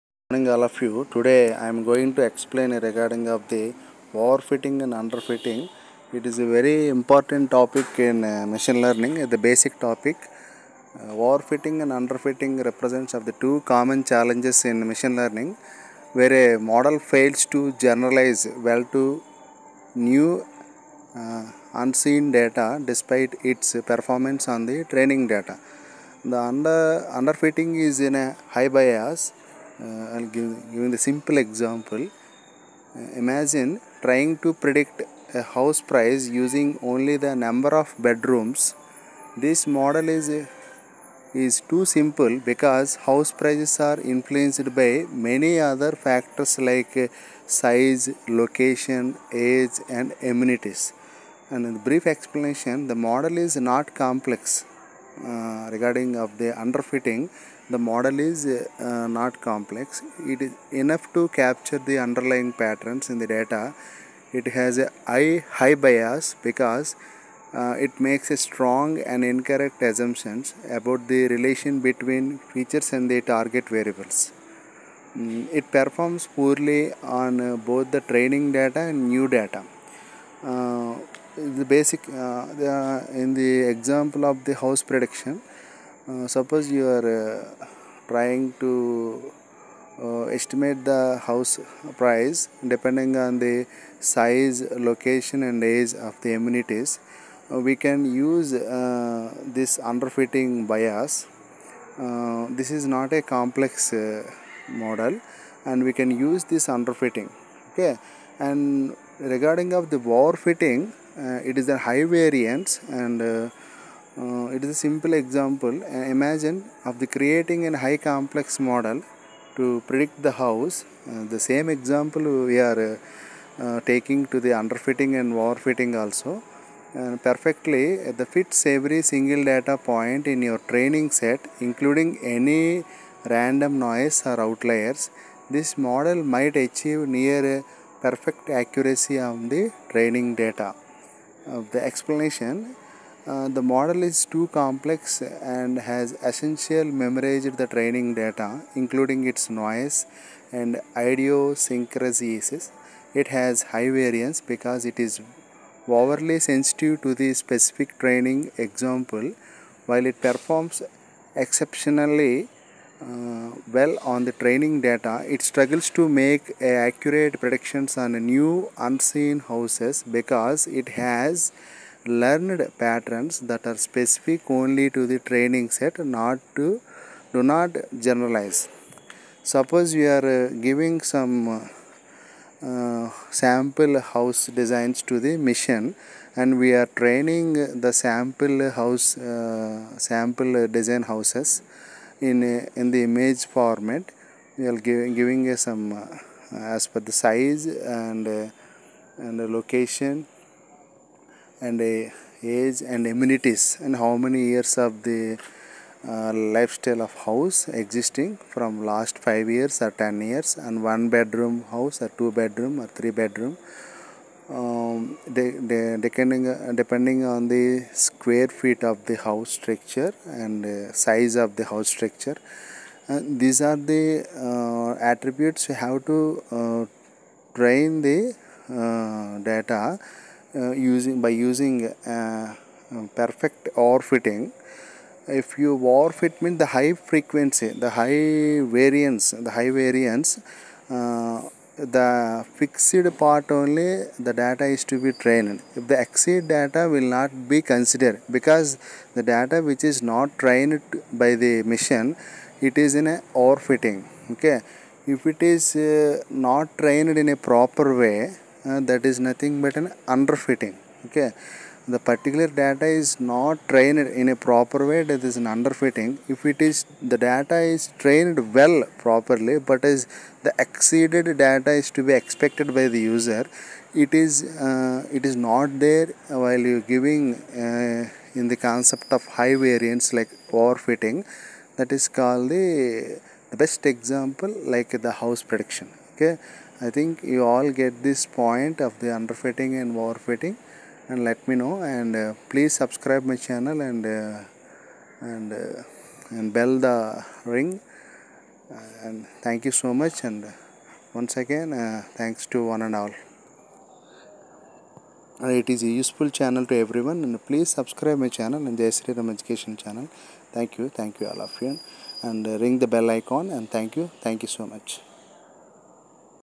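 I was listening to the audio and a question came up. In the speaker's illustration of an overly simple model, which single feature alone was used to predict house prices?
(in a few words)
number of bedrooms.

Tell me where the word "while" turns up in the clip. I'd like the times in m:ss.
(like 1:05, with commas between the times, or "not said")
2:39, 4:36.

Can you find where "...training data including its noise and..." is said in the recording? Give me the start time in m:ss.
2:27.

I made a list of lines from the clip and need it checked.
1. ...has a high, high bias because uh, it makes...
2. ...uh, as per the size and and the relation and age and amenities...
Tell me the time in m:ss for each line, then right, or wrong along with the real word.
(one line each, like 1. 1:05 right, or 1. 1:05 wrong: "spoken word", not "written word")
1. 1:04 right
2. 3:15 wrong: "location", not "relation".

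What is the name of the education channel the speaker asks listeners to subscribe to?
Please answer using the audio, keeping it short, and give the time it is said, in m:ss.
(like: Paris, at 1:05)
Jai Sriram education channel, at 5:08.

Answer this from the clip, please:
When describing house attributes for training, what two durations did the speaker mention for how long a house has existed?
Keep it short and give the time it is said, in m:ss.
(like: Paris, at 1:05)
5 years or 10 years, at 3:29.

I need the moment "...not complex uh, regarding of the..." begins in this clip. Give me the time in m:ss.
0:53.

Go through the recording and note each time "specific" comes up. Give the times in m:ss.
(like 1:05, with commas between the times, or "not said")
2:37, 2:53.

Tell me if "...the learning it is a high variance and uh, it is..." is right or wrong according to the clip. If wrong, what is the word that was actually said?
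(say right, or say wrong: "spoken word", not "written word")
wrong: "overfitting", not "learning".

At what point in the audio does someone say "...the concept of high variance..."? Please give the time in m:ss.
4:38.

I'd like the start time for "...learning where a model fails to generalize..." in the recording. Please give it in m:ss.
0:15.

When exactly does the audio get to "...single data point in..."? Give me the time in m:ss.
2:09.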